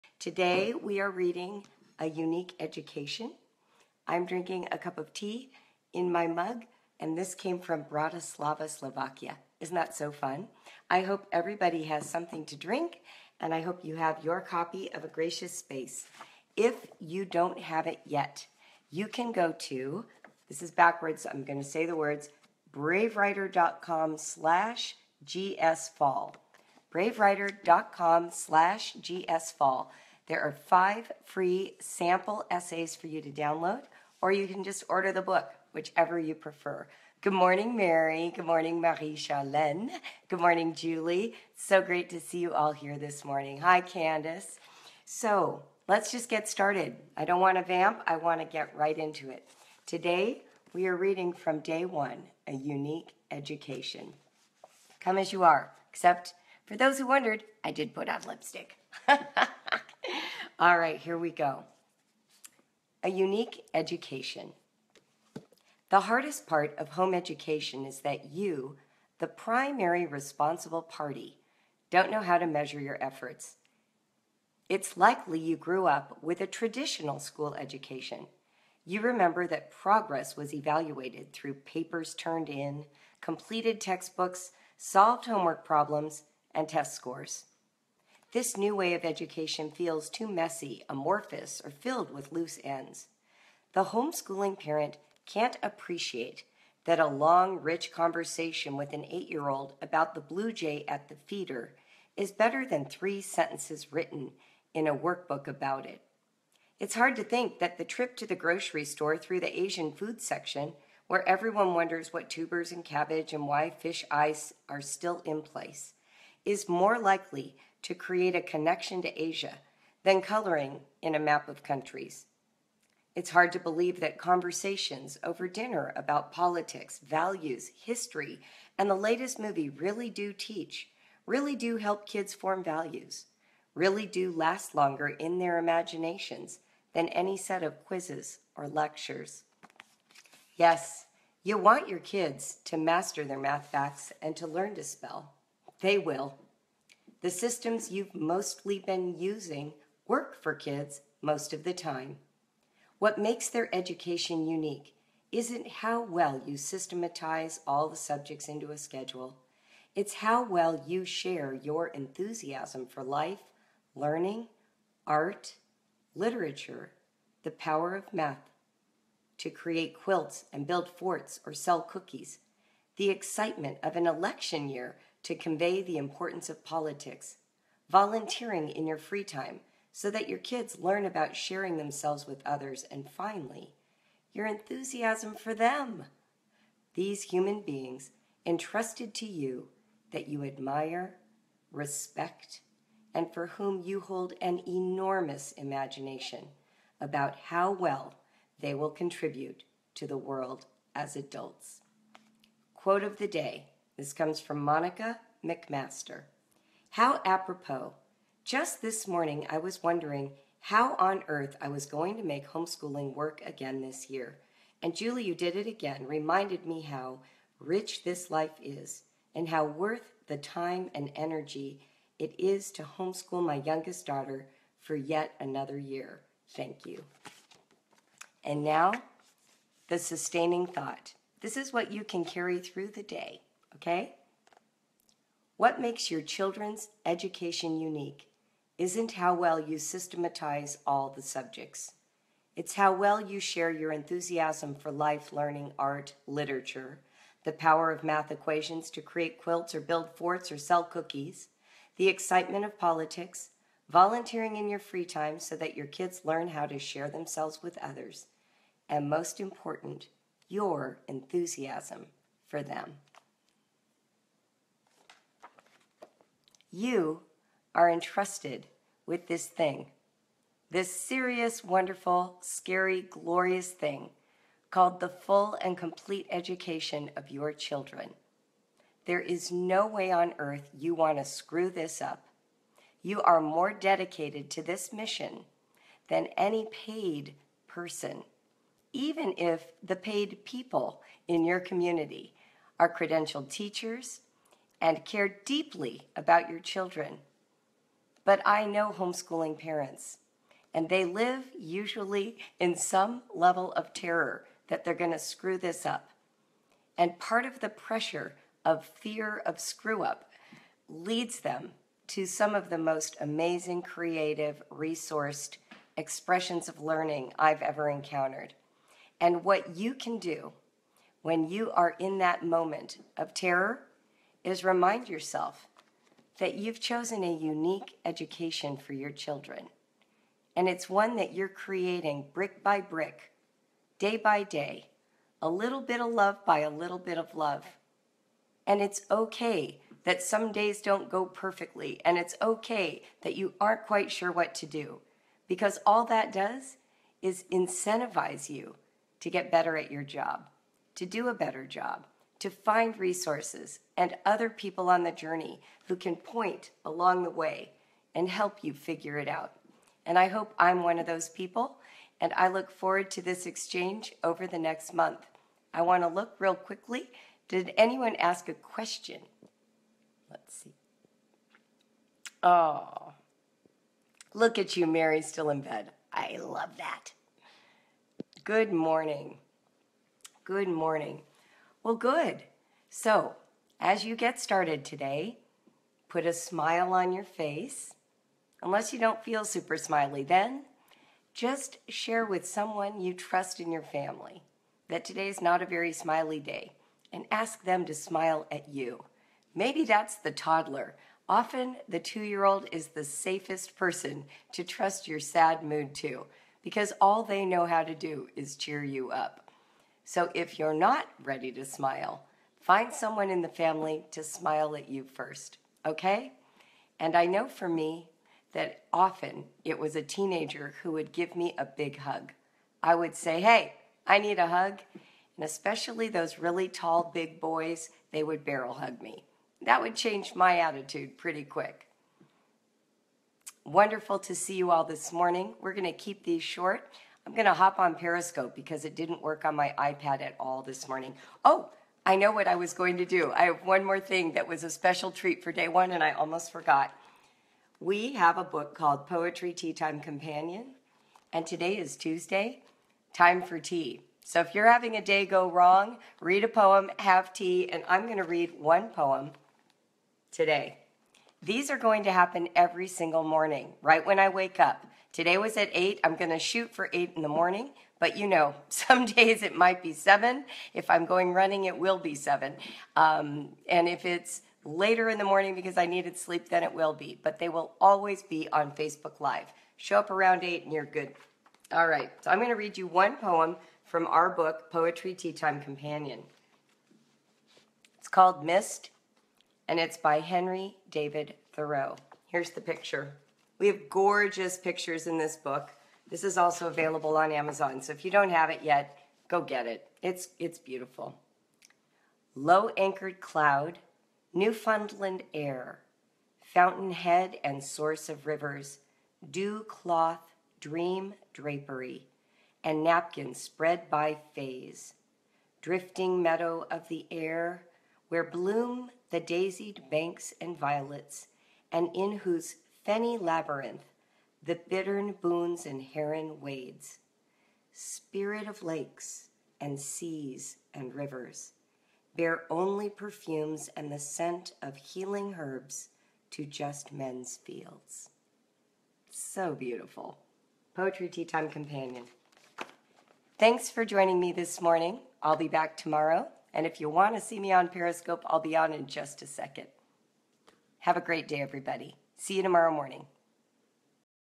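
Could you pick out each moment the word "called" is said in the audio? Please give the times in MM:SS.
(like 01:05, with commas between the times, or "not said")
04:34, 07:28, 08:08.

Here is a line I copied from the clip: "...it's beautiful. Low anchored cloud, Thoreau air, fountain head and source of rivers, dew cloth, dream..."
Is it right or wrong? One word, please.
wrong.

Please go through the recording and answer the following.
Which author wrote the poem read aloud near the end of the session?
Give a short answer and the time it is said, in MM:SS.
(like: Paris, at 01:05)
Henry David Thoreau, at 08:10.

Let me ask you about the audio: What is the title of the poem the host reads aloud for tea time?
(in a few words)
Mist.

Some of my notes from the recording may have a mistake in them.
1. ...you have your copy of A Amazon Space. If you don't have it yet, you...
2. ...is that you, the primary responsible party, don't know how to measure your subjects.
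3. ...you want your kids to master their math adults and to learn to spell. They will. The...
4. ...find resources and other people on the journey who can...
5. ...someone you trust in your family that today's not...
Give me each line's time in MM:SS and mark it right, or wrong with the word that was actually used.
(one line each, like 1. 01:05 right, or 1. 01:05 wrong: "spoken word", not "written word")
1. 00:13 wrong: "Gracious", not "Amazon"
2. 01:07 wrong: "efforts", not "subjects"
3. 02:21 wrong: "facts", not "adults"
4. 05:52 right
5. 06:32 right.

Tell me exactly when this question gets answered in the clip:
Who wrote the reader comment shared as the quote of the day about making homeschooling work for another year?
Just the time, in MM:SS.
03:24.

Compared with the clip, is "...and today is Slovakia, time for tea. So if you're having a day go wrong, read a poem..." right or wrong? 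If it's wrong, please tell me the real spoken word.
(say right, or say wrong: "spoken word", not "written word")
wrong: "Tuesday", not "Slovakia".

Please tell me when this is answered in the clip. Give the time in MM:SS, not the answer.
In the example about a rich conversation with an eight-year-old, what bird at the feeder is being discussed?
01:40.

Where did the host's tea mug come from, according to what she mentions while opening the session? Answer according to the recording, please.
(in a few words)
Bratislava, Slovakia.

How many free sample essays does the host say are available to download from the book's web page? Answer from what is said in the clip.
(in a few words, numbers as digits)
5.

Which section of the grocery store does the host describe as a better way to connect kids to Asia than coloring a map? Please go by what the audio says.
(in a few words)
Asian food section.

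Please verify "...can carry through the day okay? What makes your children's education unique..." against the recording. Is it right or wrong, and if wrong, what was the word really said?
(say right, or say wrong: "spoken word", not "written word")
right.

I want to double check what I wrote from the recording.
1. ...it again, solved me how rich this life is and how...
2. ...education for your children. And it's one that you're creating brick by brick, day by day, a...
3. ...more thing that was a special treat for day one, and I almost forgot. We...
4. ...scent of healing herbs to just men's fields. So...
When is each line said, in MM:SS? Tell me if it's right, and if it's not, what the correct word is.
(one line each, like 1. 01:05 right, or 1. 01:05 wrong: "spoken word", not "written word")
1. 03:35 wrong: "reminded", not "solved"
2. 05:28 right
3. 07:23 right
4. 08:53 right.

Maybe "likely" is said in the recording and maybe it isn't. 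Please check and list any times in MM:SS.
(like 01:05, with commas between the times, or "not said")
01:14, 01:56.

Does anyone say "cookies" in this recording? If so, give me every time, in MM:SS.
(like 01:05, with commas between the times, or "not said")
02:51, 04:10.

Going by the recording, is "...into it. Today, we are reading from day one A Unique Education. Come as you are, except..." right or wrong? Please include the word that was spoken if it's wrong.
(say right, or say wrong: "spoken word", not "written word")
right.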